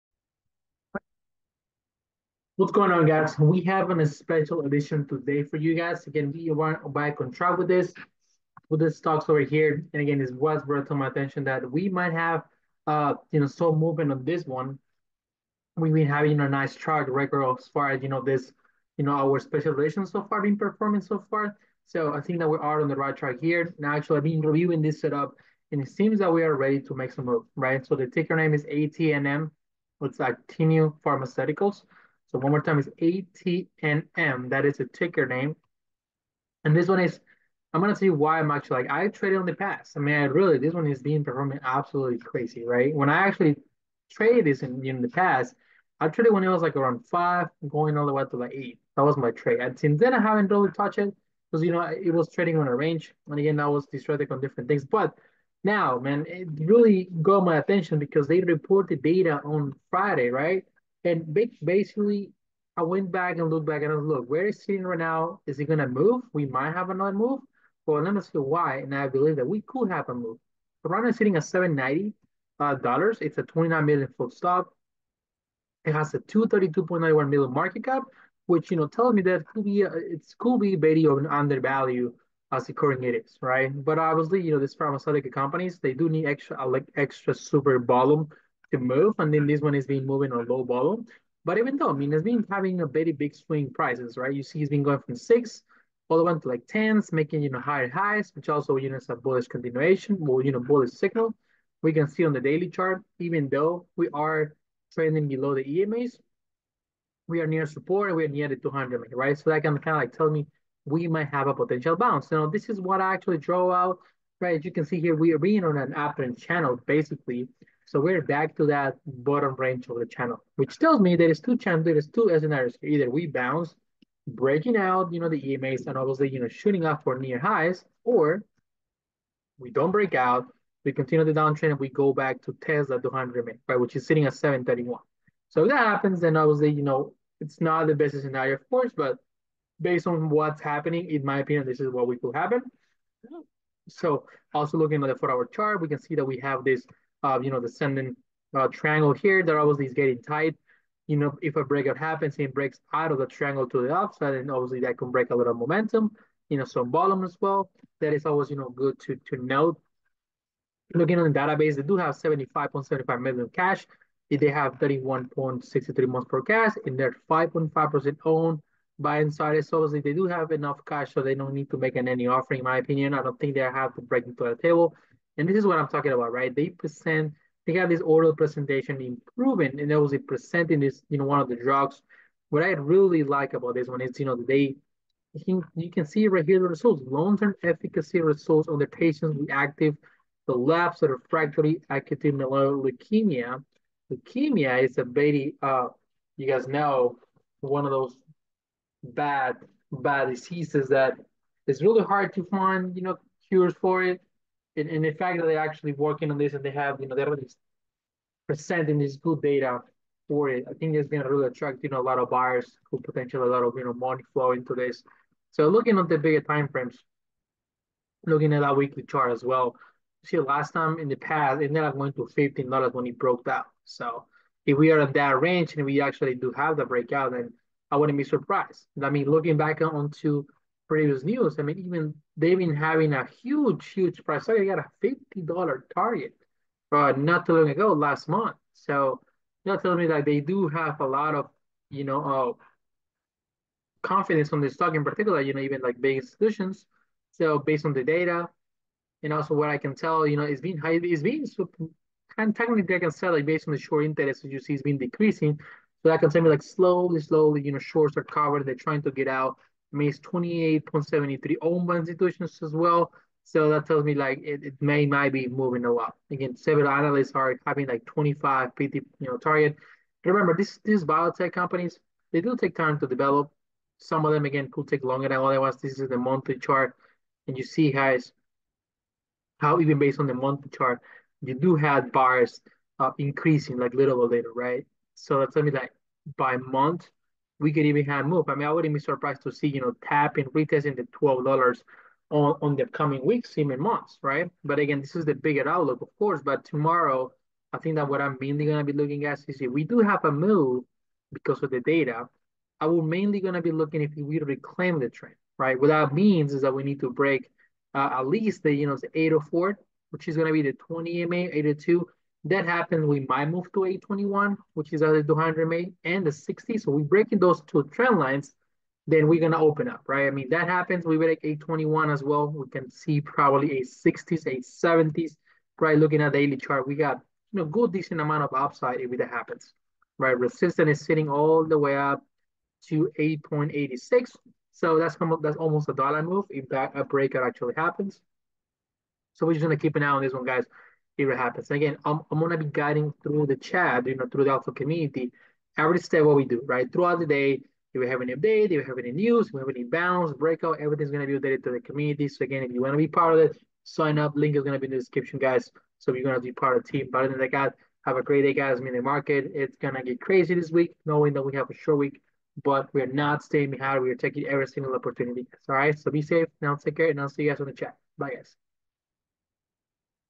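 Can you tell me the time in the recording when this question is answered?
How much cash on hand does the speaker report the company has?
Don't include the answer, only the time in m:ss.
2:42.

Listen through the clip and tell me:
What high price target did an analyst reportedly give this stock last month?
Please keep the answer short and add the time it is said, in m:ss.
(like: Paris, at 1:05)
$50, at 3:55.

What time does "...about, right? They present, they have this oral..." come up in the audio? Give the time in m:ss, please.
2:56.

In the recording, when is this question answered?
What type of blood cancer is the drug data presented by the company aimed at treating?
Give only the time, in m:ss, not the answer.
3:11.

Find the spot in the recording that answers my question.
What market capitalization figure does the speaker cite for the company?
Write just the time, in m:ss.
1:16.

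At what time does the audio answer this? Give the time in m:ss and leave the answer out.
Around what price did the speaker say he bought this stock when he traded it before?
0:46.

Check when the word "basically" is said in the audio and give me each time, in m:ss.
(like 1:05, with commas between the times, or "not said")
1:01, 1:56.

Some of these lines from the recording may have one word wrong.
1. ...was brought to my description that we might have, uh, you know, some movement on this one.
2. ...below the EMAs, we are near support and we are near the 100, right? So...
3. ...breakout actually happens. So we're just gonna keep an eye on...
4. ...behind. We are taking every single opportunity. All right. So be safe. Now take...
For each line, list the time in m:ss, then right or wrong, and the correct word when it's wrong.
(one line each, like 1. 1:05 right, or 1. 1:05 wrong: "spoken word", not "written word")
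1. 0:10 wrong: "attention", not "description"
2. 1:45 wrong: "200", not "100"
3. 5:37 right
4. 6:03 right.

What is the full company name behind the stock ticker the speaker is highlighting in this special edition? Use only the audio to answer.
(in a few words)
Actinium Pharmaceuticals.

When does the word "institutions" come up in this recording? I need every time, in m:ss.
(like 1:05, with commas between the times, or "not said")
4:06, 4:21.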